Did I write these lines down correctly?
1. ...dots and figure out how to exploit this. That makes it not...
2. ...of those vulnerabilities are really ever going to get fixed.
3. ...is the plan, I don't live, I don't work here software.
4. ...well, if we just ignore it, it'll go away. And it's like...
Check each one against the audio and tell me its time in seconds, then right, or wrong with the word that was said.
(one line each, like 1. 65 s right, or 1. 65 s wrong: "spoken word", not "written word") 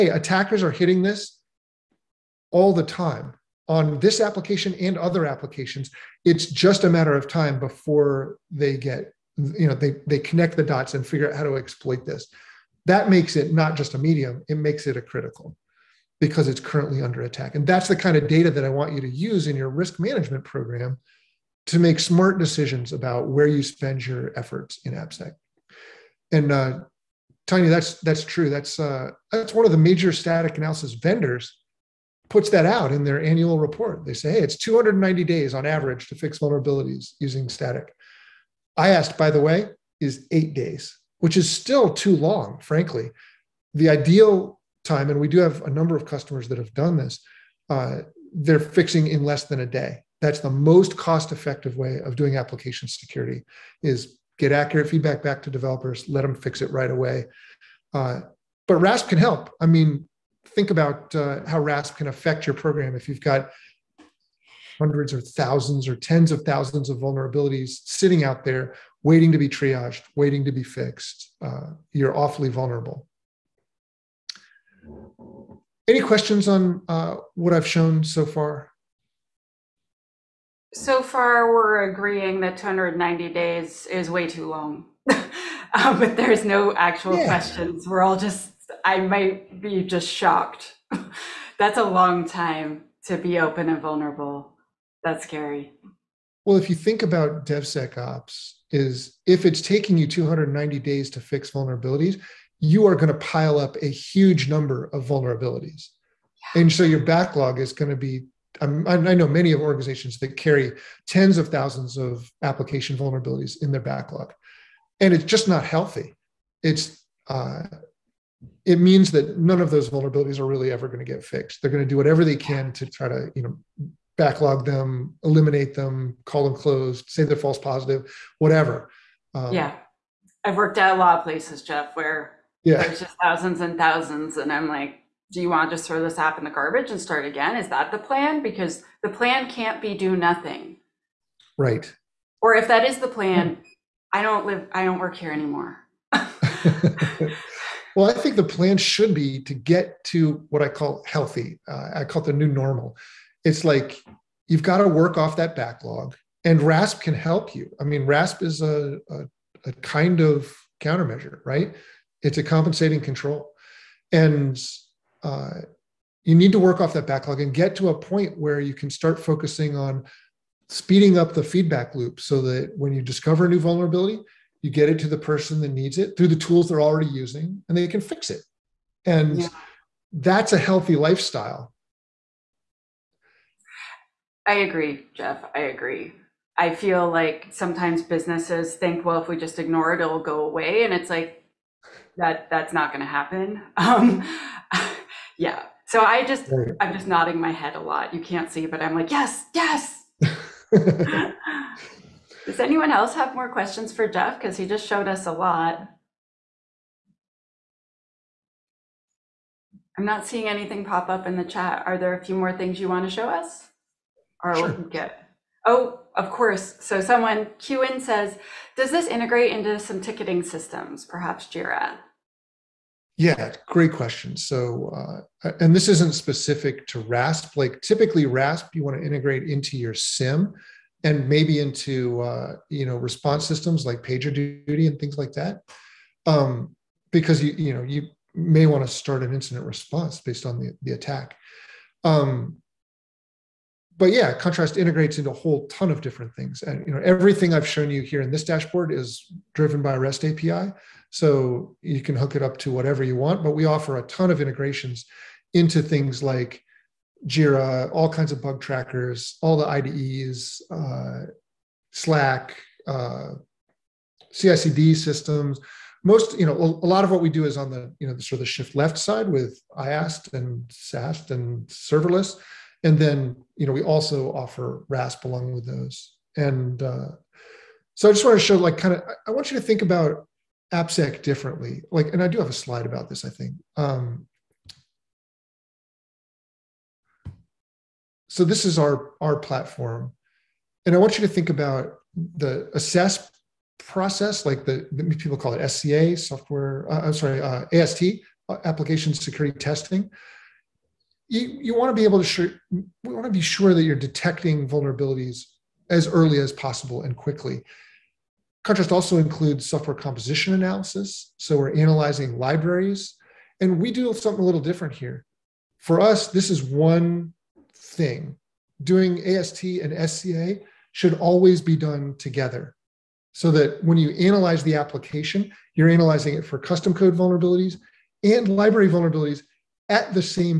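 1. 10 s right
2. 119 s right
3. 142 s wrong: "anymore", not "software"
4. 189 s right.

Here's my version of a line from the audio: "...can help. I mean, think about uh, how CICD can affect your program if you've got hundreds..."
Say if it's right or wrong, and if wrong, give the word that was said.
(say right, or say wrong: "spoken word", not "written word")
wrong: "RASP", not "CICD".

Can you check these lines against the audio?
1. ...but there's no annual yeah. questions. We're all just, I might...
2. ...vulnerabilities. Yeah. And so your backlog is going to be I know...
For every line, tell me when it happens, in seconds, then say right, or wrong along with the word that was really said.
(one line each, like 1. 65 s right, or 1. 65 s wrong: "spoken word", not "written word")
1. 85 s wrong: "actual", not "annual"
2. 105 s right.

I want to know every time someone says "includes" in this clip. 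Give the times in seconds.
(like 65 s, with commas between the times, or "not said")
309 s.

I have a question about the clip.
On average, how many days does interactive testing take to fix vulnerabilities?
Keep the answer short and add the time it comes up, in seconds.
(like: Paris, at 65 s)
8, at 40 s.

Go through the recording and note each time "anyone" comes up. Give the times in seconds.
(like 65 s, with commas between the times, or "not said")
202 s.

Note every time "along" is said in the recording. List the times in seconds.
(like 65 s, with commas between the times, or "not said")
275 s.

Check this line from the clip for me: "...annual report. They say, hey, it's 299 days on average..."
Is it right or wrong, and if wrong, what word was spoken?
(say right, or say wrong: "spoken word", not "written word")
wrong: "290", not "299".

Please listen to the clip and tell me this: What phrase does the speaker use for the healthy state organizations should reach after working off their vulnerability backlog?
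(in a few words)
the new normal.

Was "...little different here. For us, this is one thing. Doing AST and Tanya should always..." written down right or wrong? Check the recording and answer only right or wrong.
wrong.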